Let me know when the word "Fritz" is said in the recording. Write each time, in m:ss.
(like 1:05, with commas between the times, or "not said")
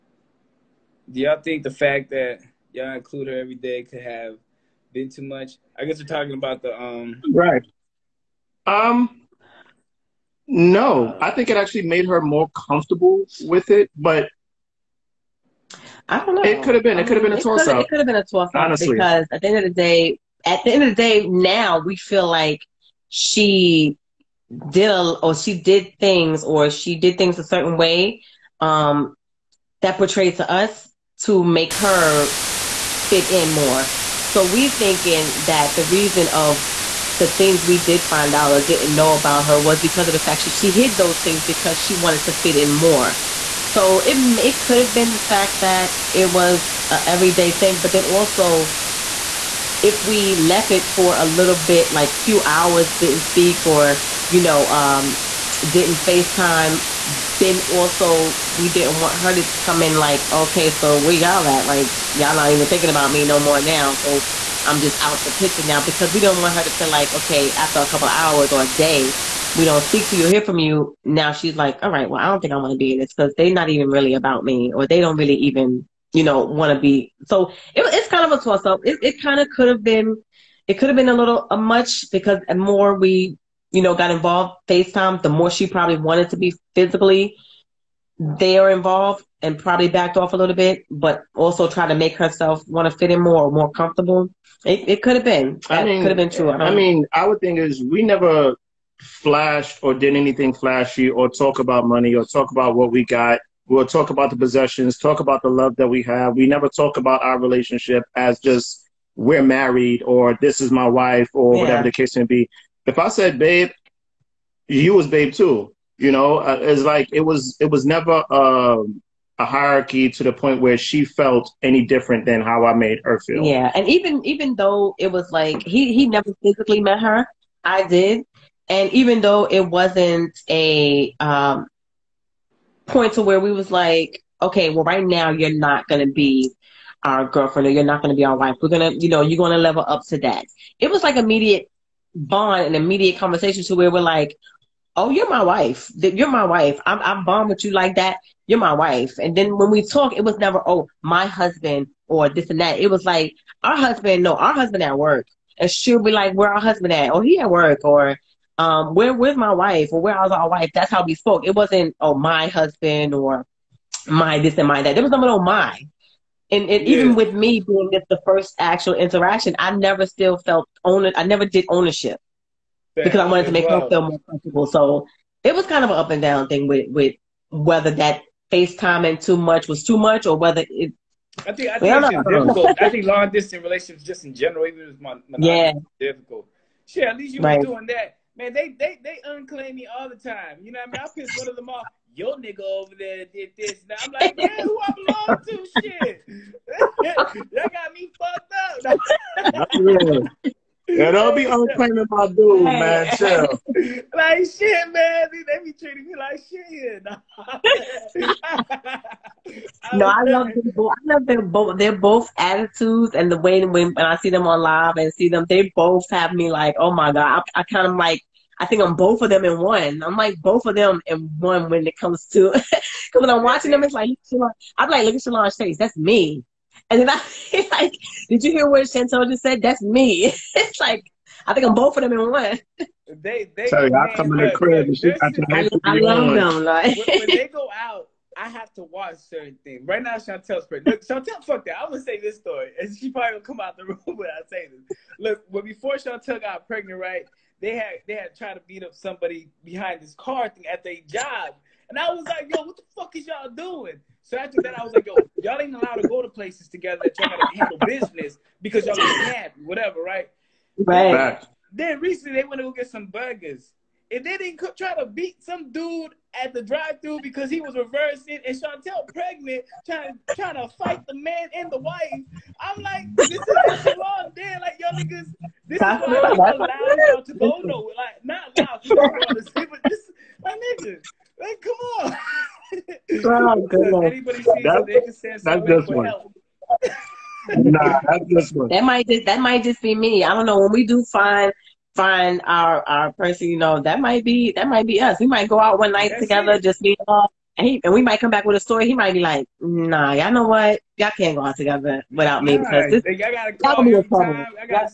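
not said.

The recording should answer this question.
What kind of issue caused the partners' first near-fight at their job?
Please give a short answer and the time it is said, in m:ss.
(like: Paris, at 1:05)
car thing, at 4:10.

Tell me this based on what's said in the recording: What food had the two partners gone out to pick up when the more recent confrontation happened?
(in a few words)
burgers.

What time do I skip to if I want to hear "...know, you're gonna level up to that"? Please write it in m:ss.
2:19.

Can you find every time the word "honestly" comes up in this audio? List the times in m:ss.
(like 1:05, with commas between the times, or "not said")
0:18.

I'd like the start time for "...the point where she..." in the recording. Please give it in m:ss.
2:00.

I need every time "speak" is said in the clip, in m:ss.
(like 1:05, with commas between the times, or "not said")
0:53, 1:09.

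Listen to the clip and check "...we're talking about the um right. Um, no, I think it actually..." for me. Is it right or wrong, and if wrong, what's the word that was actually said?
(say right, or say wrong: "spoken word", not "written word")
right.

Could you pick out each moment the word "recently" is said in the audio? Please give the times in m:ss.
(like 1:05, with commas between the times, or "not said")
4:21.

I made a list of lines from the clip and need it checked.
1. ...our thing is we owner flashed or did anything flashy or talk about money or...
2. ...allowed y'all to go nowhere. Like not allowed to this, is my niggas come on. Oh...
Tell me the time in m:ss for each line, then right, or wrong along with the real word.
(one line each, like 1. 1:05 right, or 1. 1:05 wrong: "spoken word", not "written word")
1. 1:37 wrong: "never", not "owner"
2. 4:36 right.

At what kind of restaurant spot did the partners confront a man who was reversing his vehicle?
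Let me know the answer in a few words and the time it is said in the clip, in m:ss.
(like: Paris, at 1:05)
drive-through, at 4:26.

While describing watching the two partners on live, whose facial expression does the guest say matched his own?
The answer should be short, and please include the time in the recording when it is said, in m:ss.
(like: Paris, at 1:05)
Shalon, at 3:45.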